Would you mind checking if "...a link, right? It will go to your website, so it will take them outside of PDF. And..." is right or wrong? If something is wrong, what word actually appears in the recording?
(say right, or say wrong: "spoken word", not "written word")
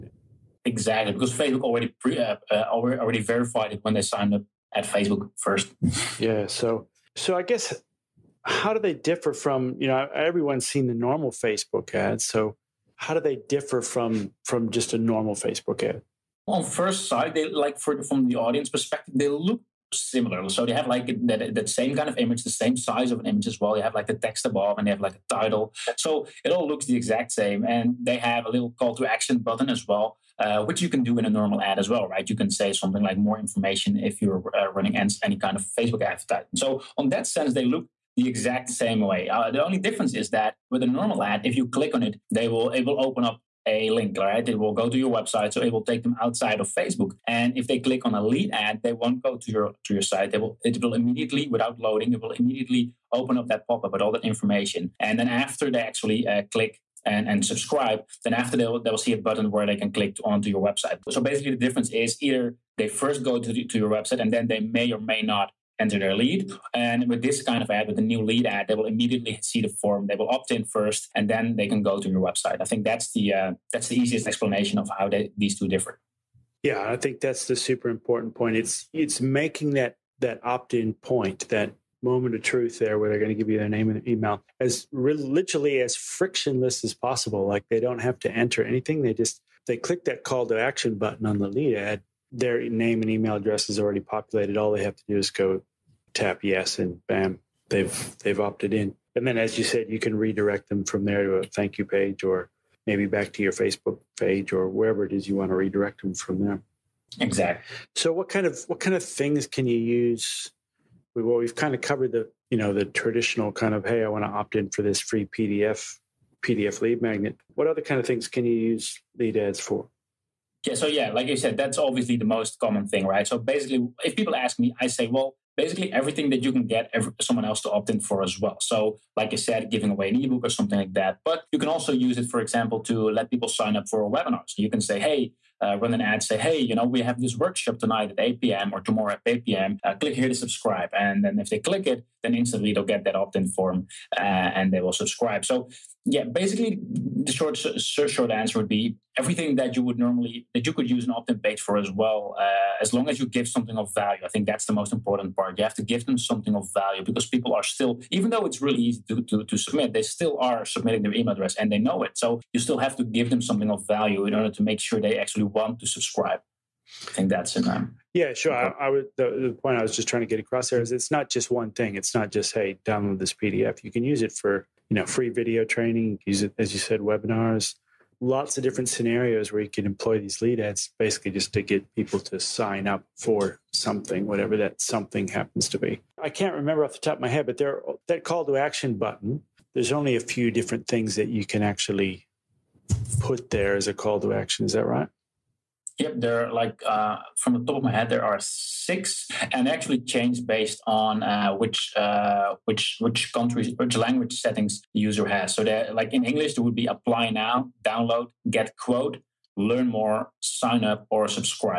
wrong: "Facebook", not "PDF".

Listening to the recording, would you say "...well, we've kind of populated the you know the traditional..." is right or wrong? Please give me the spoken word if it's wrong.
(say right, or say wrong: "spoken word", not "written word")
wrong: "covered", not "populated".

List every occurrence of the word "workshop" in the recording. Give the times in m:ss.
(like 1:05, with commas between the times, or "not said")
2:17.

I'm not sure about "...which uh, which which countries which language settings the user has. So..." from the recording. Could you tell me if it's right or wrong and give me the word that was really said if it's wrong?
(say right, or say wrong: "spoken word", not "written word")
right.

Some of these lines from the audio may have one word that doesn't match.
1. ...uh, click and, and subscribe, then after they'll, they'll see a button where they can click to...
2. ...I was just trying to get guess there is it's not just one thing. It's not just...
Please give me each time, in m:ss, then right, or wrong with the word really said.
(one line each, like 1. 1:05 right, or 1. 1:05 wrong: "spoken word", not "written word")
1. 0:56 right
2. 2:49 wrong: "across", not "guess".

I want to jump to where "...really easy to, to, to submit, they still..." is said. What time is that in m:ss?
2:38.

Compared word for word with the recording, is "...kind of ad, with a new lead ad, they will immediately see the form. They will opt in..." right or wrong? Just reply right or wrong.
right.